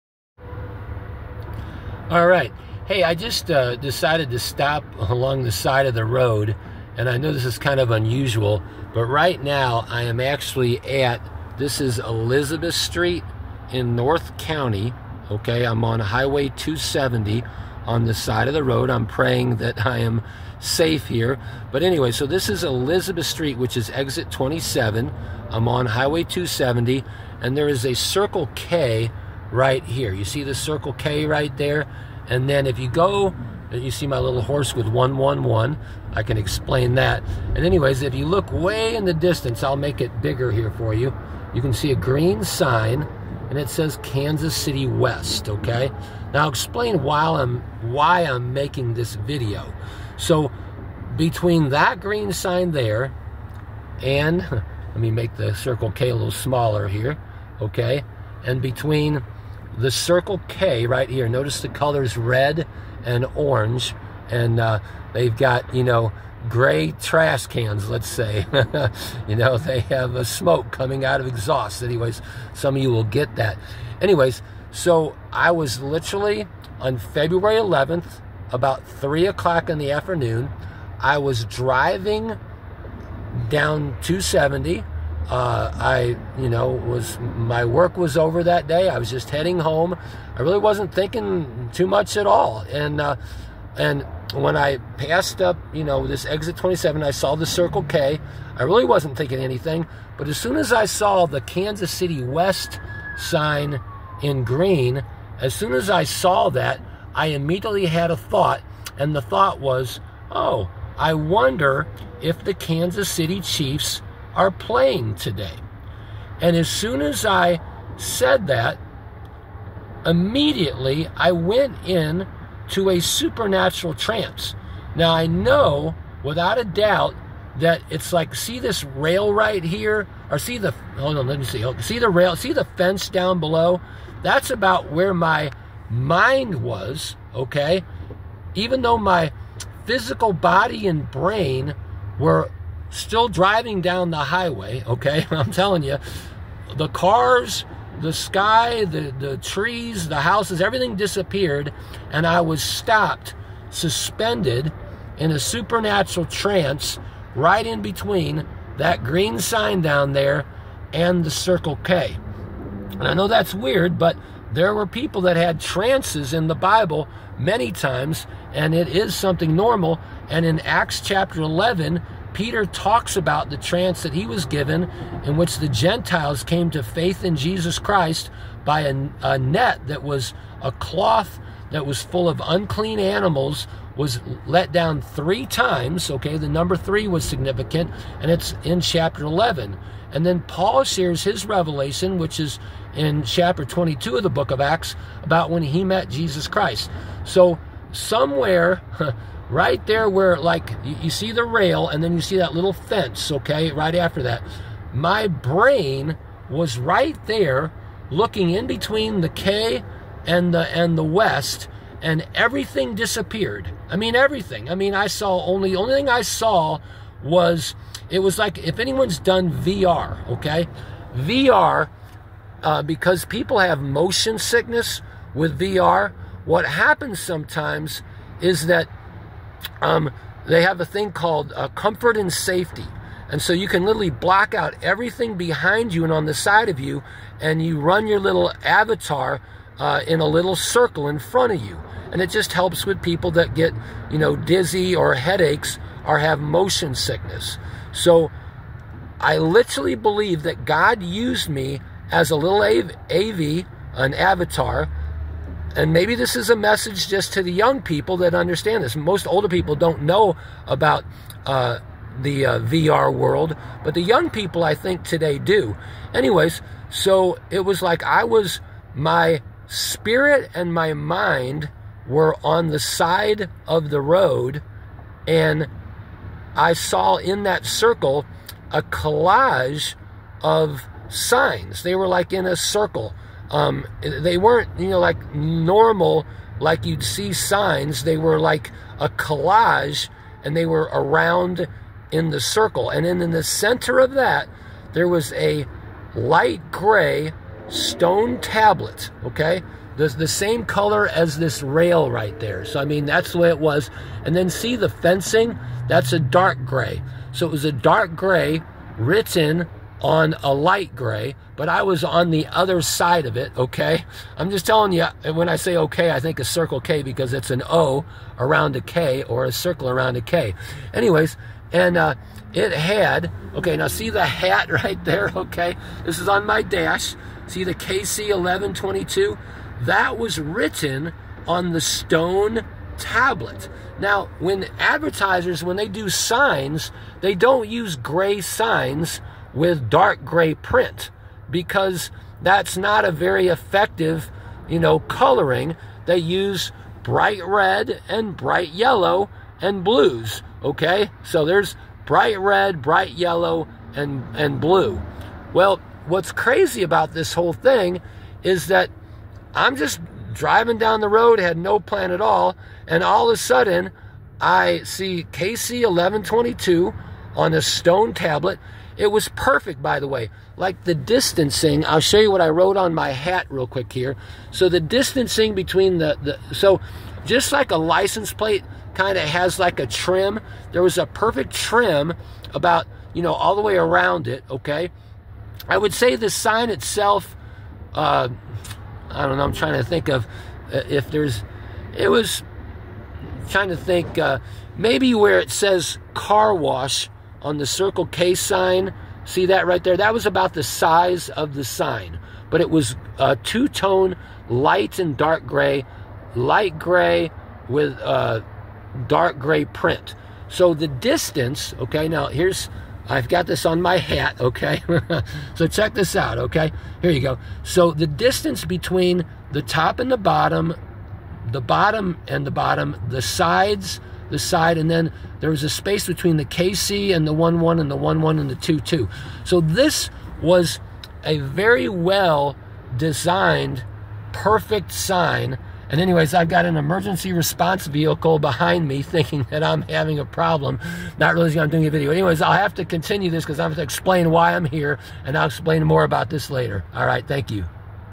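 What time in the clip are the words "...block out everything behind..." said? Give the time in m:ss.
3:54.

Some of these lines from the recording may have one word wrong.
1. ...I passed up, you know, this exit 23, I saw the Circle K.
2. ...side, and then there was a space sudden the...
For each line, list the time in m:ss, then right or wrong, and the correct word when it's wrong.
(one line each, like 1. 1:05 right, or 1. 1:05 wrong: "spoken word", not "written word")
1. 1:34 wrong: "27", not "23"
2. 7:04 wrong: "between", not "sudden".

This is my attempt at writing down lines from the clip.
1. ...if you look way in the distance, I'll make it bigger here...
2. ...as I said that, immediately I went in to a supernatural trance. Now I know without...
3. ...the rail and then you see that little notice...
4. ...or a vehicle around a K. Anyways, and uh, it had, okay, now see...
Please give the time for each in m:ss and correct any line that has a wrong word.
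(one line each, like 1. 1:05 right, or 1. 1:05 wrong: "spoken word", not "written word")
1. 0:38 right
2. 1:57 right
3. 3:21 wrong: "fence", not "notice"
4. 5:19 wrong: "circle", not "vehicle".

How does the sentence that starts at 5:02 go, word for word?
So, I mean, that's the way it was.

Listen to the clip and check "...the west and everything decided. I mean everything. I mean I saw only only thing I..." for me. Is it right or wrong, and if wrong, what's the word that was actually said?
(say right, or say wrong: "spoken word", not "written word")
wrong: "disappeared", not "decided".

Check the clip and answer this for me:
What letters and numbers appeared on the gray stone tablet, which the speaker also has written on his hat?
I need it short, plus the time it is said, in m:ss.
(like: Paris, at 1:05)
KC1122, at 5:27.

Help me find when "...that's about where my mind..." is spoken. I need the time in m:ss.
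2:14.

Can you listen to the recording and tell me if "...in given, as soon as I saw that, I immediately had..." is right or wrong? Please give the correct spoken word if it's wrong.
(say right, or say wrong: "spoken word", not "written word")
wrong: "green", not "given".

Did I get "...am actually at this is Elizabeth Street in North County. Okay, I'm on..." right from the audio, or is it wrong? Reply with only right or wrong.
right.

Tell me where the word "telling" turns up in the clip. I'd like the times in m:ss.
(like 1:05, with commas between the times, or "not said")
2:25, 5:14.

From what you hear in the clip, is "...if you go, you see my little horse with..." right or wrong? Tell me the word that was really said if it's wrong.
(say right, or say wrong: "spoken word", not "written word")
right.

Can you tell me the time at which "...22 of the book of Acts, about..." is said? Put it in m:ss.
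3:13.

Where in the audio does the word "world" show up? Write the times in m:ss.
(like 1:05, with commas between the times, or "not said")
4:23.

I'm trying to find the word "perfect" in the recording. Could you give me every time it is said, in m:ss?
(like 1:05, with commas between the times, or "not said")
6:09, 6:21, 7:14.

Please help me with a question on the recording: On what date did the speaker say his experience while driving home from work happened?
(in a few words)
February 11th.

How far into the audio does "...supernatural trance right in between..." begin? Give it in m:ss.
2:35.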